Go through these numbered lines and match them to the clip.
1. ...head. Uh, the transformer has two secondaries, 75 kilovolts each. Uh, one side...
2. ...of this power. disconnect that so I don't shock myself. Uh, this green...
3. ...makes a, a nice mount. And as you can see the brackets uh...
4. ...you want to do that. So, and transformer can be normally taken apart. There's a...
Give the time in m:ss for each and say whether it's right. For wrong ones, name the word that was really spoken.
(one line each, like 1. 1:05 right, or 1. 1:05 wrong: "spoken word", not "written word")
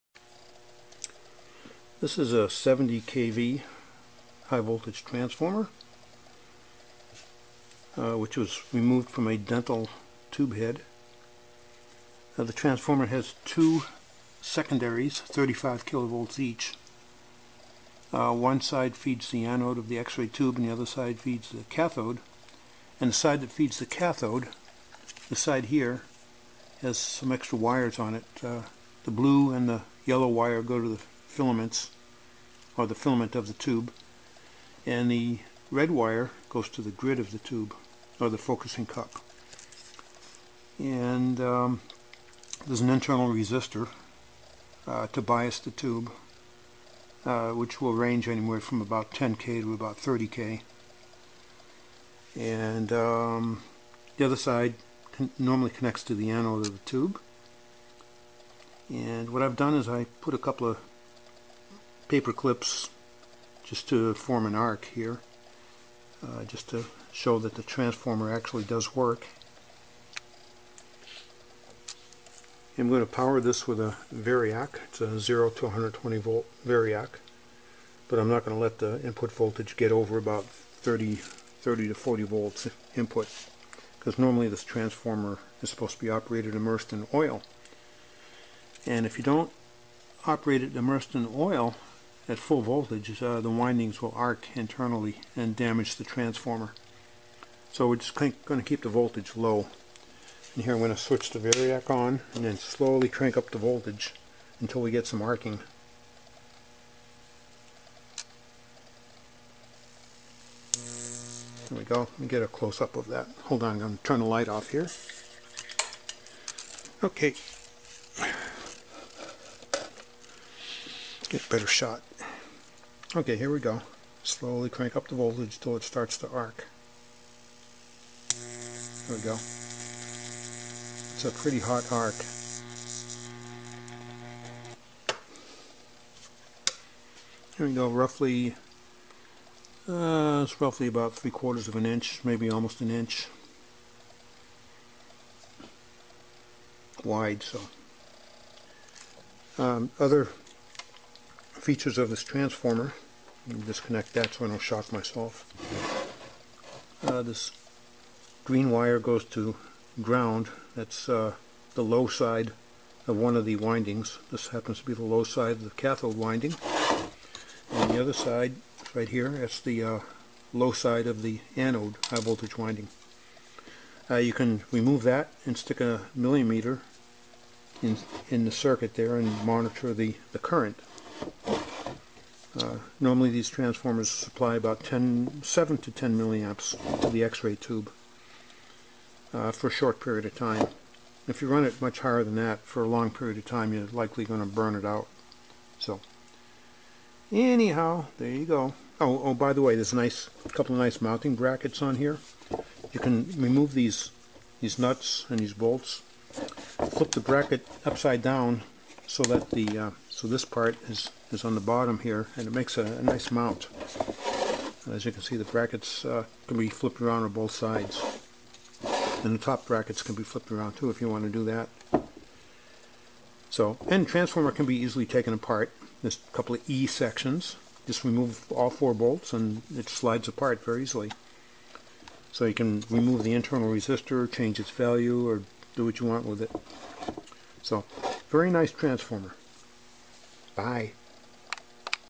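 1. 0:10 wrong: "35", not "75"
2. 2:31 wrong: "transformer", not "power"
3. 3:32 right
4. 3:41 wrong: "easily", not "normally".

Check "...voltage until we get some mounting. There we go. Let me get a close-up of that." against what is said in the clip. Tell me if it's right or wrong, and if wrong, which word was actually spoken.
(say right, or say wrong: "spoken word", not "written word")
wrong: "arcing", not "mounting".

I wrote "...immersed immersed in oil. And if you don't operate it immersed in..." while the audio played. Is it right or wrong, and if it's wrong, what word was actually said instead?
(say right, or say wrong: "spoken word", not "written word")
wrong: "operated", not "immersed".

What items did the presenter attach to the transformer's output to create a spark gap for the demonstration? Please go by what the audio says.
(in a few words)
paper clips.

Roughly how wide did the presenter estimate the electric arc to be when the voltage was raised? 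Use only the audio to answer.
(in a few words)
3/4 inch.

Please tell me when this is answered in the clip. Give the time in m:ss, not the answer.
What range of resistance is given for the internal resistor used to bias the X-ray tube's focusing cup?
0:49.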